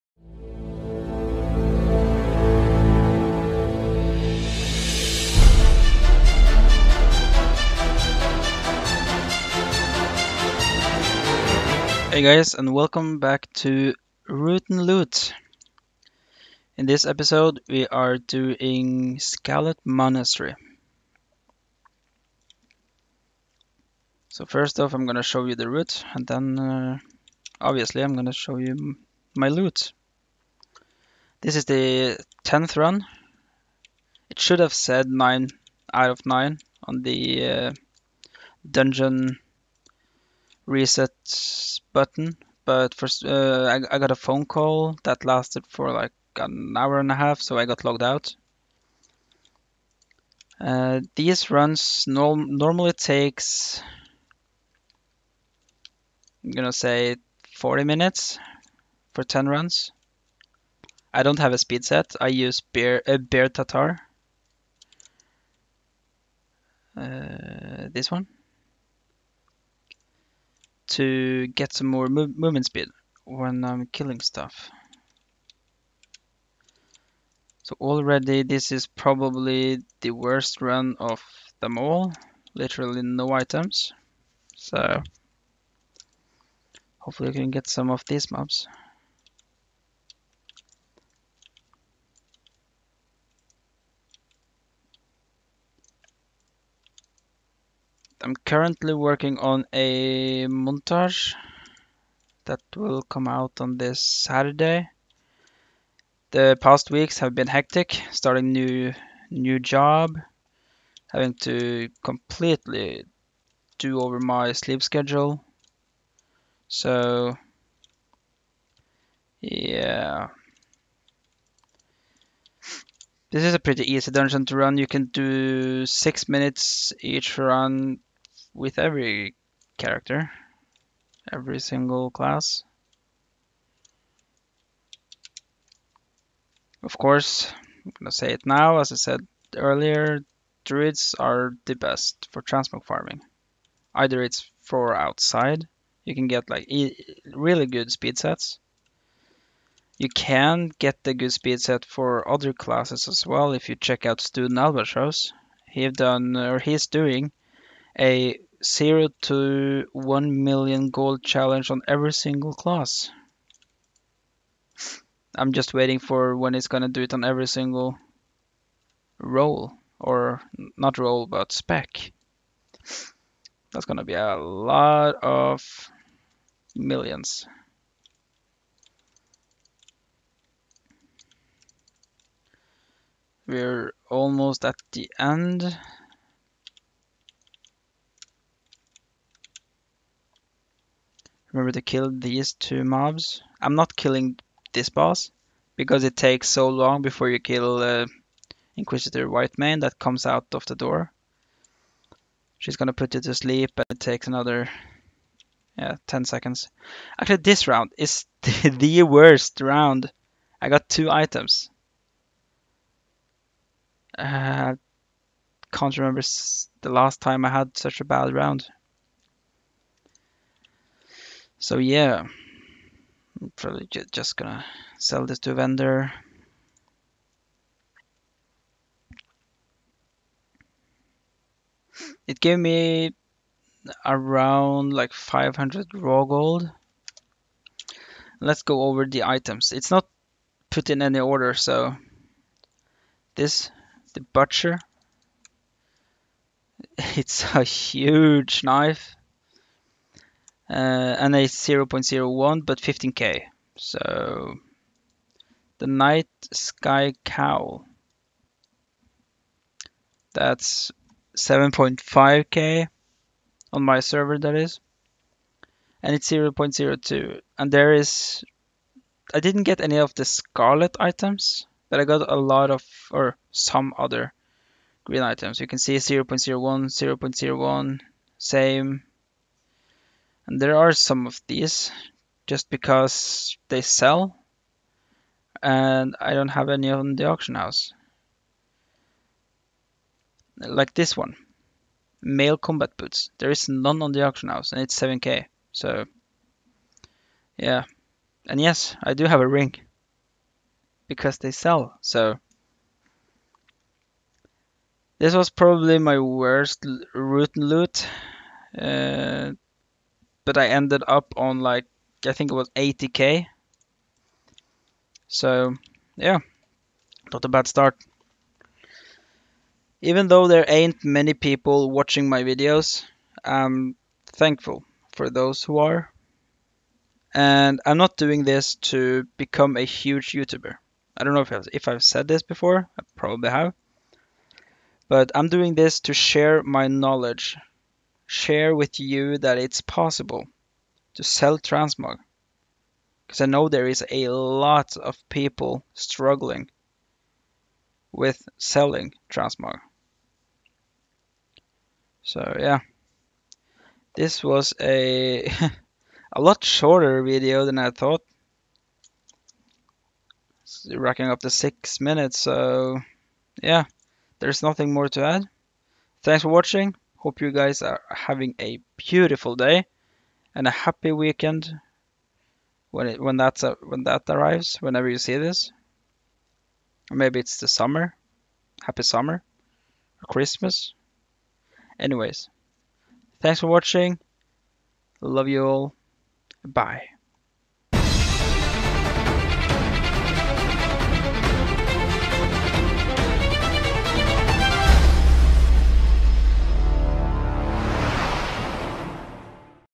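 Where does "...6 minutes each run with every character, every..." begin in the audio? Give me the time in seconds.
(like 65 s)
125 s.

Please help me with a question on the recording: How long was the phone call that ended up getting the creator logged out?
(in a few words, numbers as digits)
an hour and a half.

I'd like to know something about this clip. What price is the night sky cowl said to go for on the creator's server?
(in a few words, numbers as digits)
7.5k.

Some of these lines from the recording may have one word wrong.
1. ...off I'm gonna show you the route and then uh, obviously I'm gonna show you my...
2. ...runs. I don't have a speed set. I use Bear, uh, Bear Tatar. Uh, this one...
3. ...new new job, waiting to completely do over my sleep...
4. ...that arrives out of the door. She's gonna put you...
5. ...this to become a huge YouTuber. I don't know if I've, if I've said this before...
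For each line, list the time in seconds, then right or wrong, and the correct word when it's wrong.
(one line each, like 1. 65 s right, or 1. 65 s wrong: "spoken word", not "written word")
1. 24 s right
2. 59 s right
3. 108 s wrong: "having", not "waiting"
4. 199 s wrong: "comes", not "arrives"
5. 328 s right.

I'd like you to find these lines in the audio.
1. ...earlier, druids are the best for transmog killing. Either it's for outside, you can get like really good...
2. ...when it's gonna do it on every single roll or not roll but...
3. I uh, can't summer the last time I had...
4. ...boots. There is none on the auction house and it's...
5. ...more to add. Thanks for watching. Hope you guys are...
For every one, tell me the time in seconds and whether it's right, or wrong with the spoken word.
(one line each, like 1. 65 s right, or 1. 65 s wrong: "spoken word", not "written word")
1. 139 s wrong: "farming", not "killing"
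2. 166 s right
3. 214 s wrong: "remember", not "summer"
4. 292 s right
5. 364 s right.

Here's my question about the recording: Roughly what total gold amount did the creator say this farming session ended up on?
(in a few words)
80k.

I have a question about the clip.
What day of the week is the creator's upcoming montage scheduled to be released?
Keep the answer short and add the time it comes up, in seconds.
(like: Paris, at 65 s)
Saturday, at 103 s.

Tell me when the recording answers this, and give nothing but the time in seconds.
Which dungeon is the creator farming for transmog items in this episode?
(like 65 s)
19 s.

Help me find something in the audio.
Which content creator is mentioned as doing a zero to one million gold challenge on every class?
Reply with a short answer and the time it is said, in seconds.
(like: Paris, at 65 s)
Student Albatross, at 154 s.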